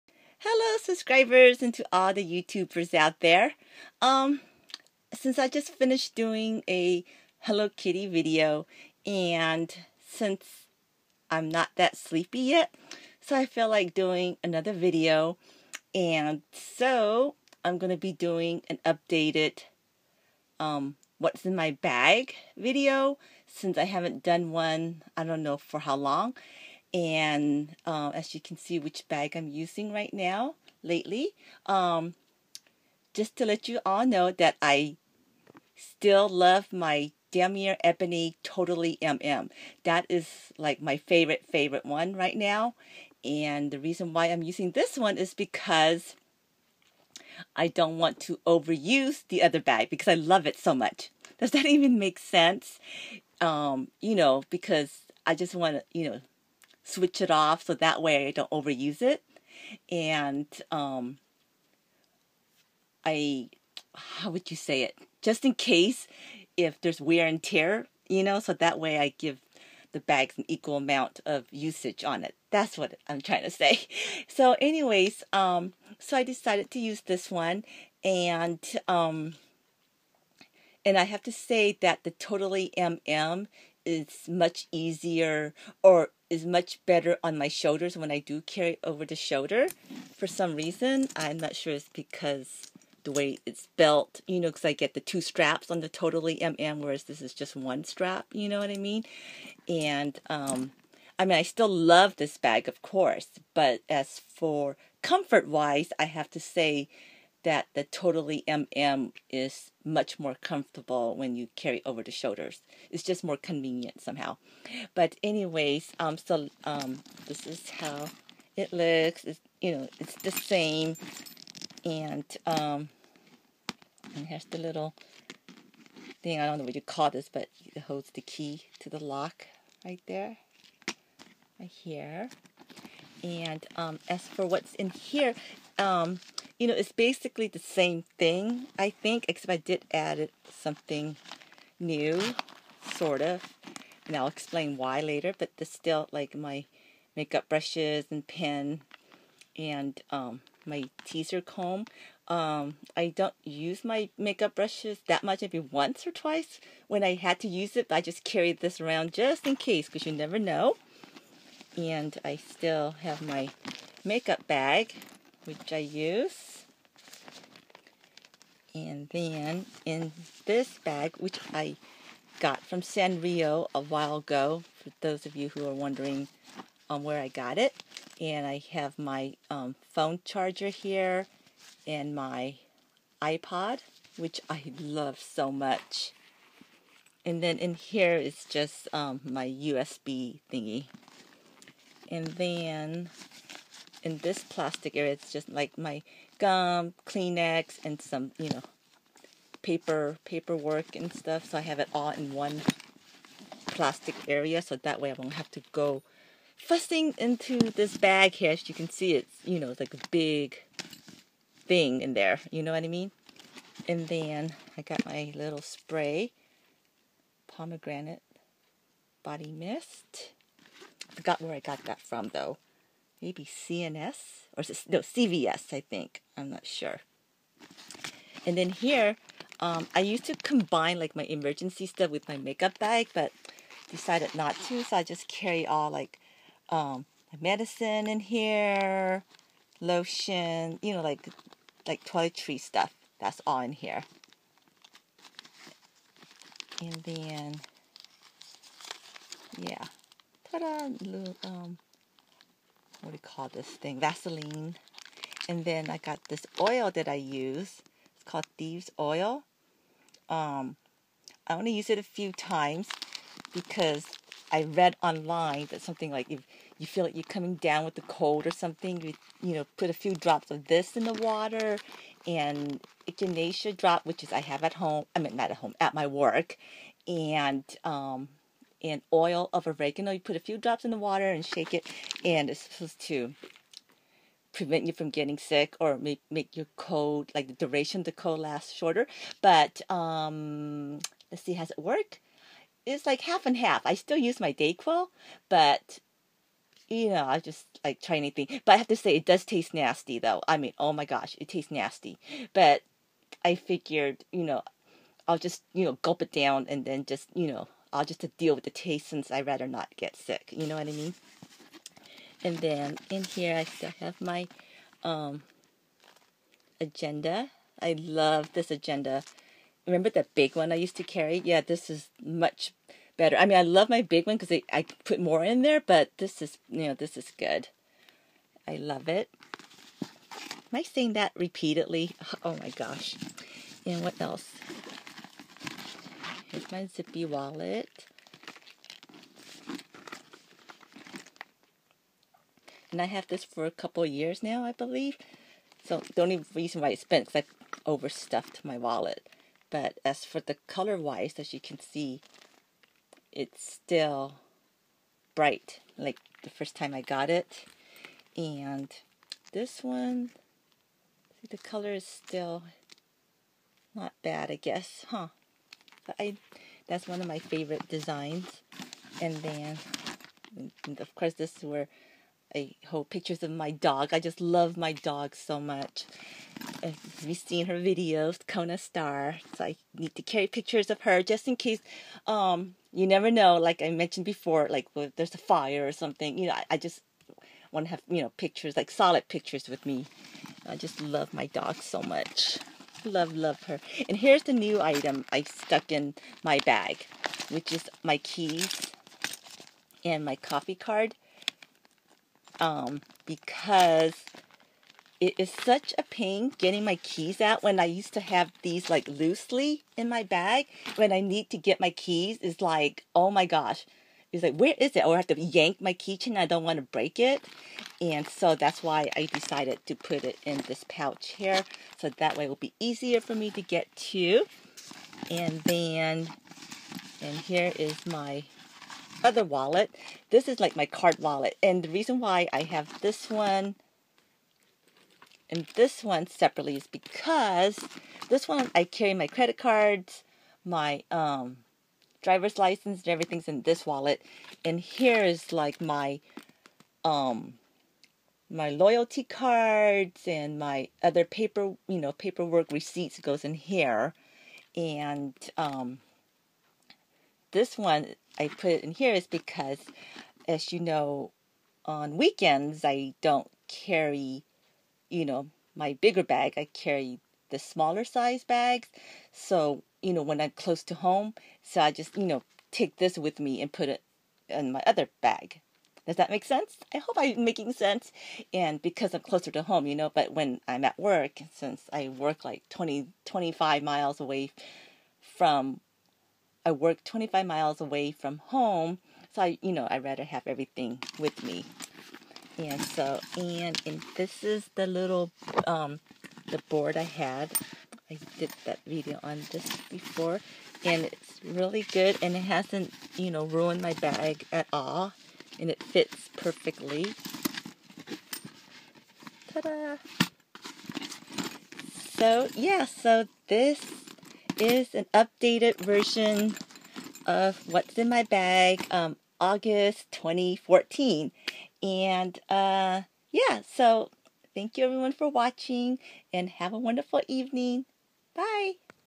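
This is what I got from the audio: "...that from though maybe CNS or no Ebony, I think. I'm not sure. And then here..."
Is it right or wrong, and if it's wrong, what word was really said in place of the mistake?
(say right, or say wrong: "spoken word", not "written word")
wrong: "CVS", not "Ebony".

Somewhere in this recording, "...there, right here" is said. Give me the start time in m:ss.
2:10.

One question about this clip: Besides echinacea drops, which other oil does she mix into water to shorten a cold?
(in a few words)
oil of oregano.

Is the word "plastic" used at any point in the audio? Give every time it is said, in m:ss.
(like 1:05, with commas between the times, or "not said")
3:14, 3:23.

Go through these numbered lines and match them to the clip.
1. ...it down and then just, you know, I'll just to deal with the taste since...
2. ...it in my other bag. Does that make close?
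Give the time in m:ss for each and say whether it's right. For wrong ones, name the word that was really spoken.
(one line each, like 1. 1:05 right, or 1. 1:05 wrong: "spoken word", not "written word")
1. 5:06 right
2. 7:53 wrong: "sense", not "close".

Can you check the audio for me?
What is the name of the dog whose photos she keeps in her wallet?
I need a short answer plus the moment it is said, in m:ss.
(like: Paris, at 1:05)
Kona Star, at 6:18.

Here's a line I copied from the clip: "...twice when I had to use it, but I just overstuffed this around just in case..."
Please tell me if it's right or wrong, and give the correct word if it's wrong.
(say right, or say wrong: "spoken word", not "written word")
wrong: "carried", not "overstuffed".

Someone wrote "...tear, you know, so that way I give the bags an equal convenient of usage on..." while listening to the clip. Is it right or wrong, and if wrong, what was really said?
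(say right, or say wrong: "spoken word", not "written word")
wrong: "amount", not "convenient".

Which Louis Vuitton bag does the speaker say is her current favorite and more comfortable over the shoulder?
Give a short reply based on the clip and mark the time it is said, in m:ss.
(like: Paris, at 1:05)
Damier Ebony Totally MM, at 0:37.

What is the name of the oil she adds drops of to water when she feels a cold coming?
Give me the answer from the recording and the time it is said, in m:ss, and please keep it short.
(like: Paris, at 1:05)
Thieves Oil, at 4:18.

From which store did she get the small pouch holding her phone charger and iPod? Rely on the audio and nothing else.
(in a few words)
Sanrio.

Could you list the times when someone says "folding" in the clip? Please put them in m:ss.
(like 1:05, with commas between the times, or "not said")
not said.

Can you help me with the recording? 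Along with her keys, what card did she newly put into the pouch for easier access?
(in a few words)
coffee card.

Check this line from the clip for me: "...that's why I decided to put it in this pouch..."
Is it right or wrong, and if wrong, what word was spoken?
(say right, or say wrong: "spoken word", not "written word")
right.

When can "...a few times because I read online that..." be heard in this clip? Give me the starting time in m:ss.
4:21.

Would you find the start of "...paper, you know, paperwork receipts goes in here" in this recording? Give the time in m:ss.
7:31.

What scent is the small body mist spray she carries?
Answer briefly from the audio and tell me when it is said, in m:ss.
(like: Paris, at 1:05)
pomegranate, at 3:37.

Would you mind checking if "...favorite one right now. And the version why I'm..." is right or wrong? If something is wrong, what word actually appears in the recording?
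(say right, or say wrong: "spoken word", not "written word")
wrong: "reason", not "version".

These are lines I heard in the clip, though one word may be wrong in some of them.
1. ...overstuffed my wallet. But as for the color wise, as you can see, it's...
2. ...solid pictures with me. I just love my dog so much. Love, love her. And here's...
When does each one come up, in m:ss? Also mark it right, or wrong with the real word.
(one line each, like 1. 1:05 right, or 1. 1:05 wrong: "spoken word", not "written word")
1. 5:47 right
2. 6:28 right.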